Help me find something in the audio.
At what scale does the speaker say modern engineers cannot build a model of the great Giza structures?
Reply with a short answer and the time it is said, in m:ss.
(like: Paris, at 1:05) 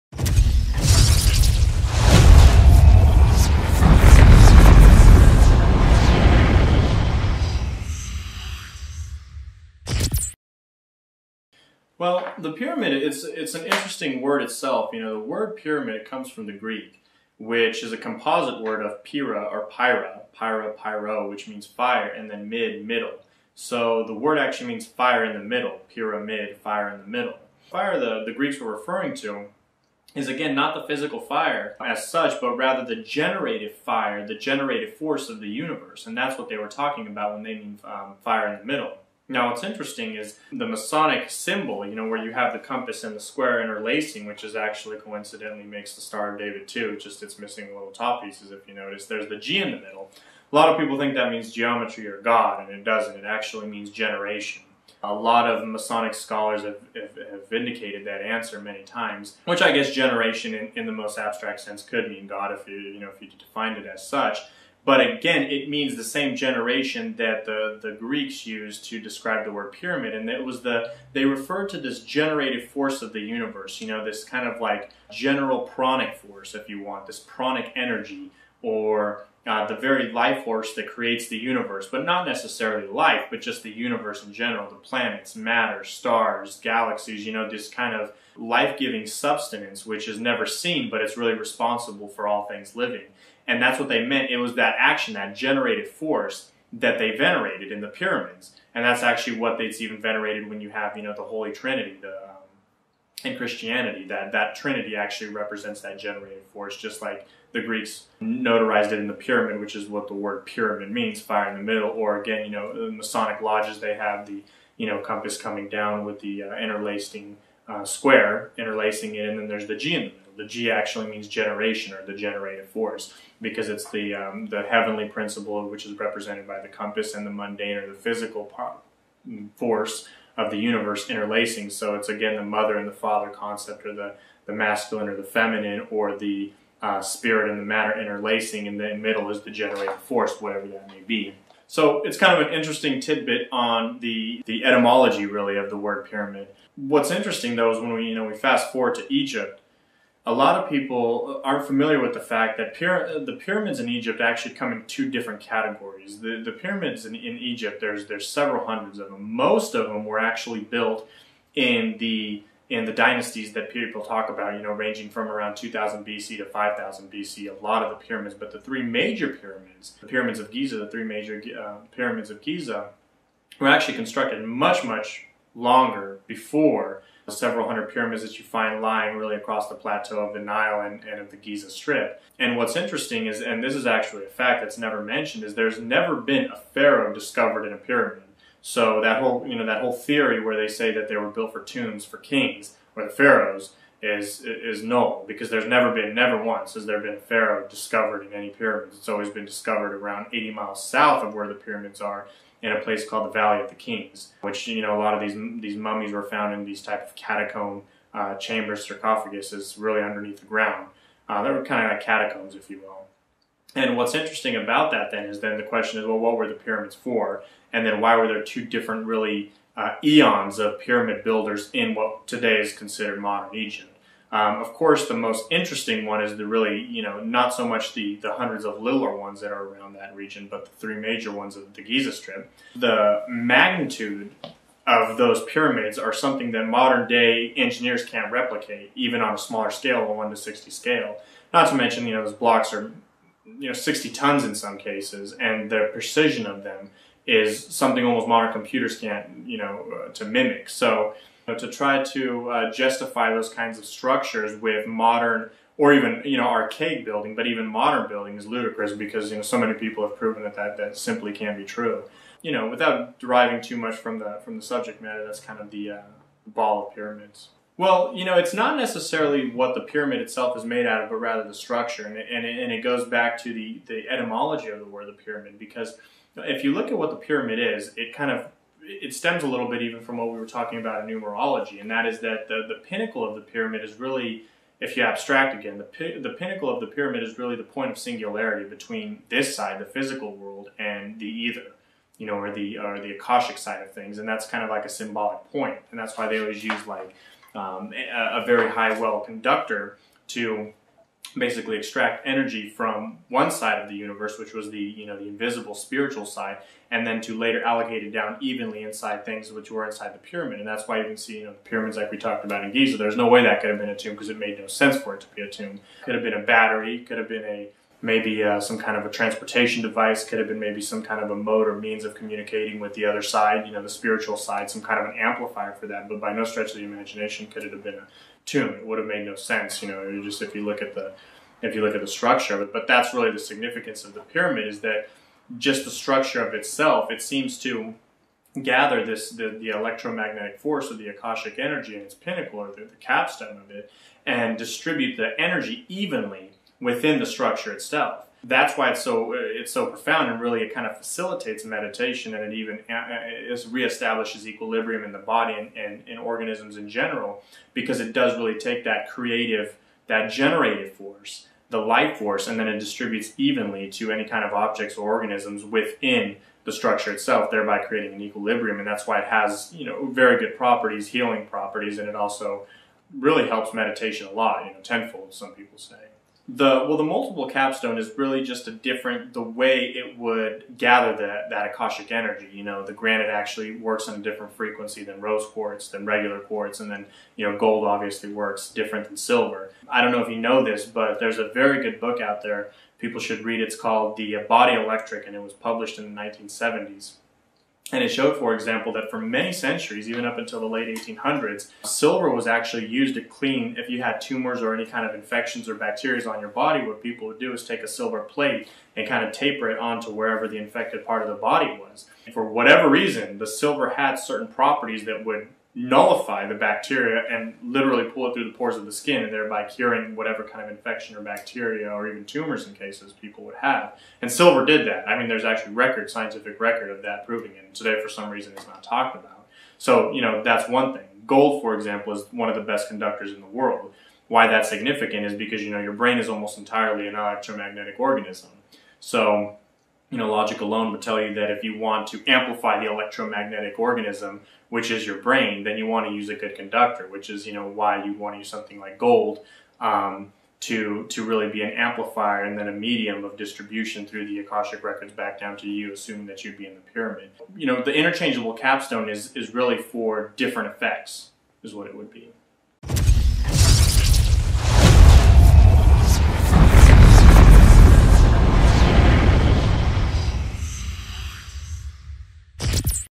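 1 to 60, at 4:00.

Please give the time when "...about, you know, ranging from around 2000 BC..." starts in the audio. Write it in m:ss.
2:44.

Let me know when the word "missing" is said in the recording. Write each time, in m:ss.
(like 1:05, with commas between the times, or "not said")
0:47.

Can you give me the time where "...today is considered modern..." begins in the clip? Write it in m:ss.
3:42.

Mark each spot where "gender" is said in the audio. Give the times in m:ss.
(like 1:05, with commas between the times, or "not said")
not said.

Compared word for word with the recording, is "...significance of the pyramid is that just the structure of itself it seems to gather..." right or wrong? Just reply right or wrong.
right.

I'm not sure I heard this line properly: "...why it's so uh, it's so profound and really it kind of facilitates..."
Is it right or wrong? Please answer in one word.
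right.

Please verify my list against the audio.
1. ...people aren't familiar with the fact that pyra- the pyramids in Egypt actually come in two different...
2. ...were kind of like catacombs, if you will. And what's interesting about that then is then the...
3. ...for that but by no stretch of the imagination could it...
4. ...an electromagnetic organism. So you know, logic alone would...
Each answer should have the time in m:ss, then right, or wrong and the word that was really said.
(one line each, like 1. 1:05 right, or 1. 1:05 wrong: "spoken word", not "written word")
1. 2:30 right
2. 3:31 right
3. 5:25 right
4. 7:17 right.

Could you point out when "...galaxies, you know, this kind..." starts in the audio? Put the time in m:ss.
1:26.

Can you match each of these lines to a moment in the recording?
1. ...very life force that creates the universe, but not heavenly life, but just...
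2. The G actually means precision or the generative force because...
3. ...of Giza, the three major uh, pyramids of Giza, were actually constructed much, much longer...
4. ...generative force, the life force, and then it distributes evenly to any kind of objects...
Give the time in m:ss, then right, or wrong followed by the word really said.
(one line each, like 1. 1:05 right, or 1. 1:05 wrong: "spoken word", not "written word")
1. 1:19 wrong: "necessarily", not "heavenly"
2. 2:00 wrong: "generation", not "precision"
3. 2:50 right
4. 6:00 right.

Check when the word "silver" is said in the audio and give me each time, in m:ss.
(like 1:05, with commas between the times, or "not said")
6:29, 6:41, 6:47, 6:53, 7:04.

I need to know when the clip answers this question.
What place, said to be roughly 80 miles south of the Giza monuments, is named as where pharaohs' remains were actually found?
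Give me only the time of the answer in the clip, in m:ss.
3:23.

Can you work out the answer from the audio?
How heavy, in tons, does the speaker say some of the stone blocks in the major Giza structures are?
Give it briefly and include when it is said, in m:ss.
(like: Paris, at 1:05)
60 tons, at 4:03.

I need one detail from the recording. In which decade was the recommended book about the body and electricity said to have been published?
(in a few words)
1970s.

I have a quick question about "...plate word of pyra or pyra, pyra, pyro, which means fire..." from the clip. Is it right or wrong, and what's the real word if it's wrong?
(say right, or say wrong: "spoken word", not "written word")
wrong: "composite", not "plate".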